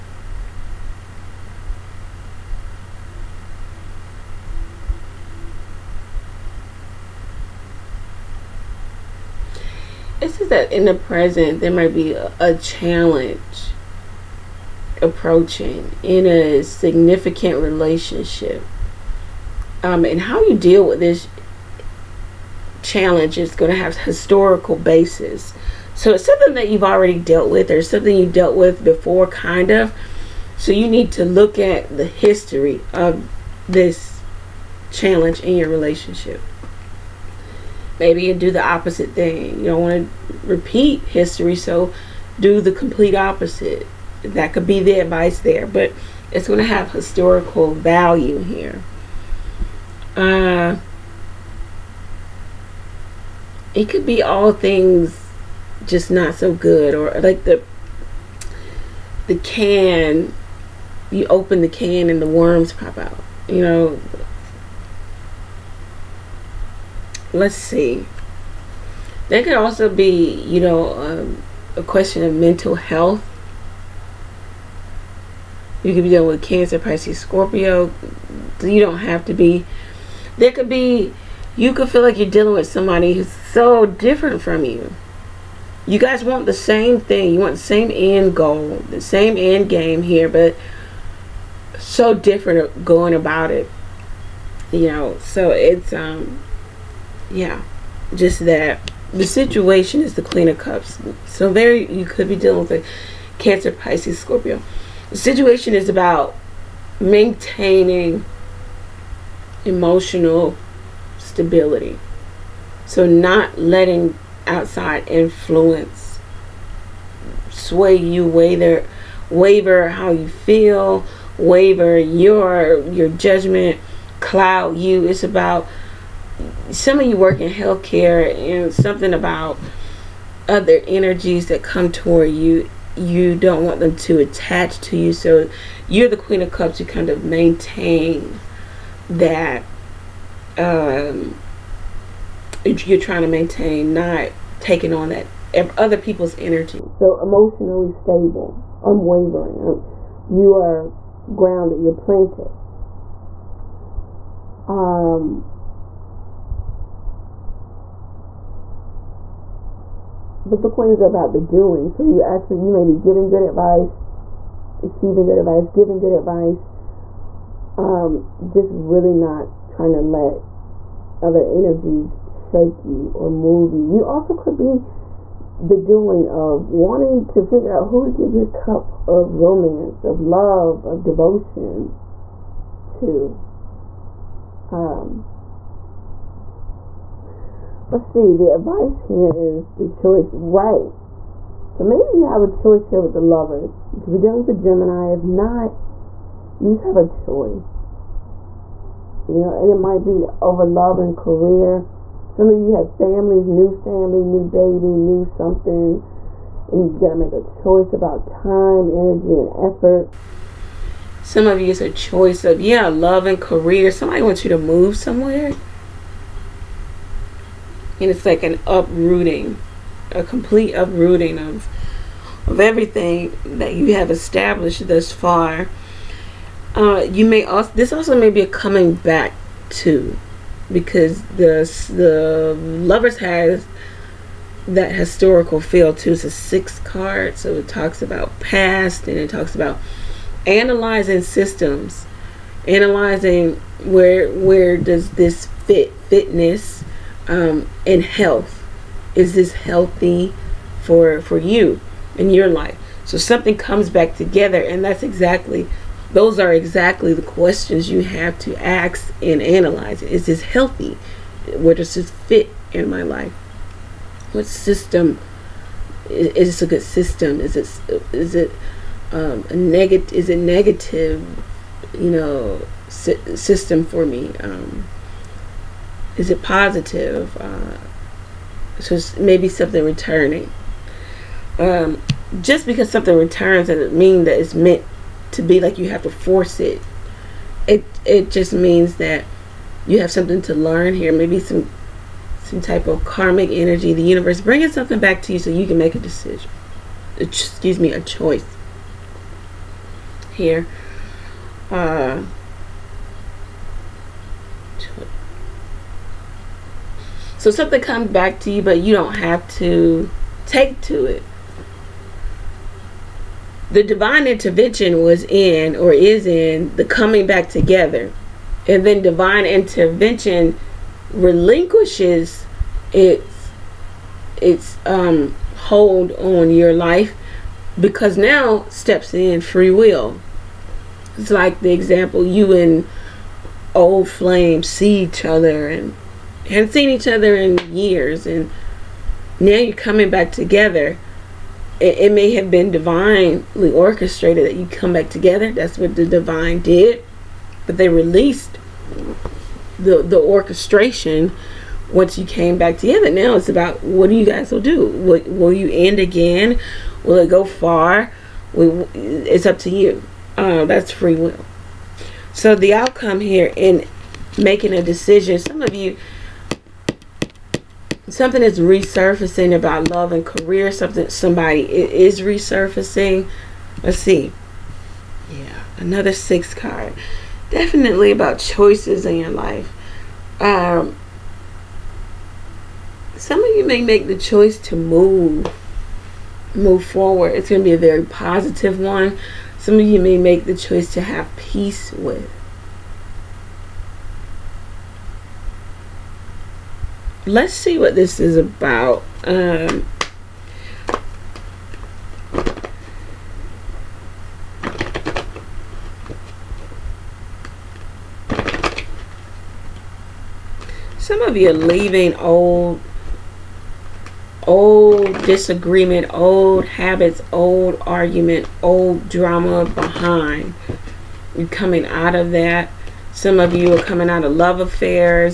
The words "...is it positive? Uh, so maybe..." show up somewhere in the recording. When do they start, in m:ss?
4:36.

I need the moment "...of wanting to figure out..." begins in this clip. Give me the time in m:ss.
2:56.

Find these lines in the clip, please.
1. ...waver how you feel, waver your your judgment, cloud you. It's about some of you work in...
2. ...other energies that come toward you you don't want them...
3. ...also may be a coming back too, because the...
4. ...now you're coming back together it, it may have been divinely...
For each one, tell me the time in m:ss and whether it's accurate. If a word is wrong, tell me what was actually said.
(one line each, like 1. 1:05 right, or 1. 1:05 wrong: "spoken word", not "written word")
1. 1:59 right
2. 2:10 right
3. 3:47 right
4. 5:39 right.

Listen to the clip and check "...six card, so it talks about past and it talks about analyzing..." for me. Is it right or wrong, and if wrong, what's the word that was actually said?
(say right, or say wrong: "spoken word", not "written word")
right.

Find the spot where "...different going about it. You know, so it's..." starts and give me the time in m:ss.
1:32.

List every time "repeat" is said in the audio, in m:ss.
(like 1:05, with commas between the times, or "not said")
0:40.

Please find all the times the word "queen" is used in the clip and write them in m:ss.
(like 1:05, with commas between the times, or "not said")
1:40, 2:16, 2:40.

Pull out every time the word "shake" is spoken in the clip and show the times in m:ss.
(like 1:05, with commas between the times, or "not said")
2:52.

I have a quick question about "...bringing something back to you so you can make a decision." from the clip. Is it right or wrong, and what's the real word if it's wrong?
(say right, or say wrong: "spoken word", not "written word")
right.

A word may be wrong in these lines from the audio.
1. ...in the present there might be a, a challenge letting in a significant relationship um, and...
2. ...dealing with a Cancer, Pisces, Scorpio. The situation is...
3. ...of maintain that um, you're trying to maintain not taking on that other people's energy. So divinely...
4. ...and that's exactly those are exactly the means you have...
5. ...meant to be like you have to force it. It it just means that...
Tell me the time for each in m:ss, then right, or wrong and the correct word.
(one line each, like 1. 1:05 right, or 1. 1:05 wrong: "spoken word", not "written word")
1. 0:10 wrong: "approaching", not "letting"
2. 1:42 right
3. 2:17 wrong: "emotionally", not "divinely"
4. 4:14 wrong: "questions", not "means"
5. 4:44 right.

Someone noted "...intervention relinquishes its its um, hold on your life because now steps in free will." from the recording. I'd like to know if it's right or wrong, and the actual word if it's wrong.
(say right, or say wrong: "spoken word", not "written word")
right.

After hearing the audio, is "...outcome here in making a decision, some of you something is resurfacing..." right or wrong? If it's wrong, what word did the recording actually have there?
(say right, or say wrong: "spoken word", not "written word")
right.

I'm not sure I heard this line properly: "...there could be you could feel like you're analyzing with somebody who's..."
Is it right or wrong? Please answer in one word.
wrong.